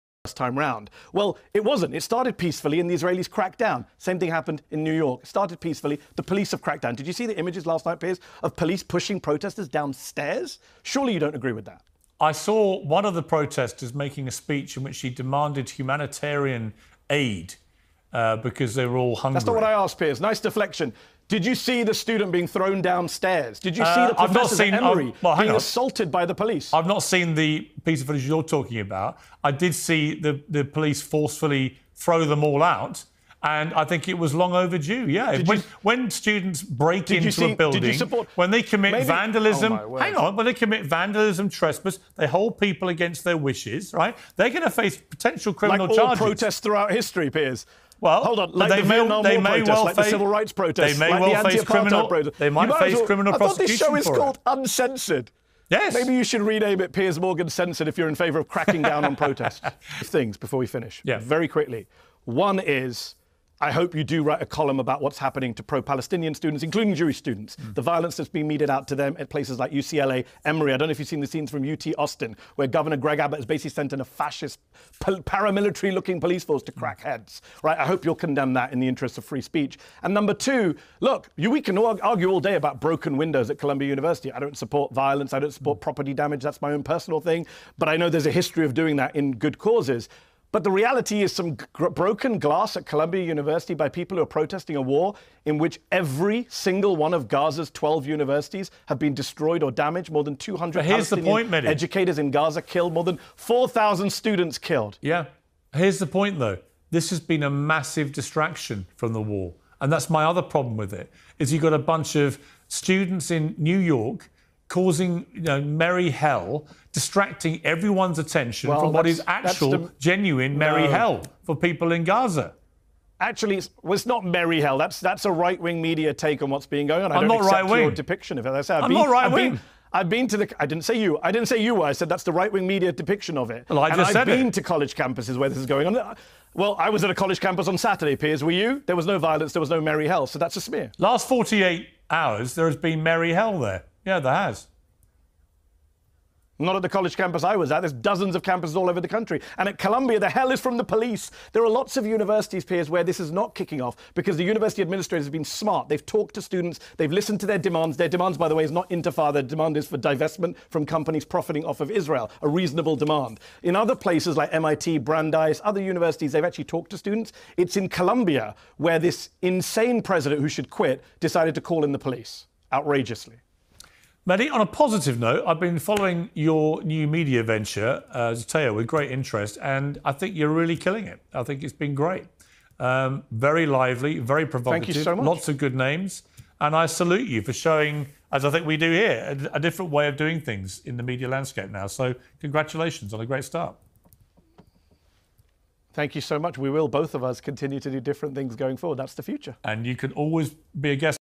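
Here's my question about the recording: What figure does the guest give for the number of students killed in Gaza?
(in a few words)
More than 4,000.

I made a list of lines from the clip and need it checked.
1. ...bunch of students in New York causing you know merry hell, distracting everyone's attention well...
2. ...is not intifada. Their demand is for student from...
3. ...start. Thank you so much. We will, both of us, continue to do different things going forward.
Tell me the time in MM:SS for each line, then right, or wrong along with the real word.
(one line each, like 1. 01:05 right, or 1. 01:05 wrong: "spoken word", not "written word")
1. 01:51 right
2. 02:38 wrong: "divestment", not "student"
3. 03:13 right.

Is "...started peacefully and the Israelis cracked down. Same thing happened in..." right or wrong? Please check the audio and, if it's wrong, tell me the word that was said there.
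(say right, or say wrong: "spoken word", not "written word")
right.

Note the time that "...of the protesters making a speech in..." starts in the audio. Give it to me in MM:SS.
00:13.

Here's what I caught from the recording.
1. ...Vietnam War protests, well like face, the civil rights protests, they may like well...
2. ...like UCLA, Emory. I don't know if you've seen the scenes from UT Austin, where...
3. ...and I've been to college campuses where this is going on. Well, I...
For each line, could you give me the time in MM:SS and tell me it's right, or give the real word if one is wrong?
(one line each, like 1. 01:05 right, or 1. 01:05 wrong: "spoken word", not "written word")
1. 00:48 right
2. 01:09 right
3. 02:14 right.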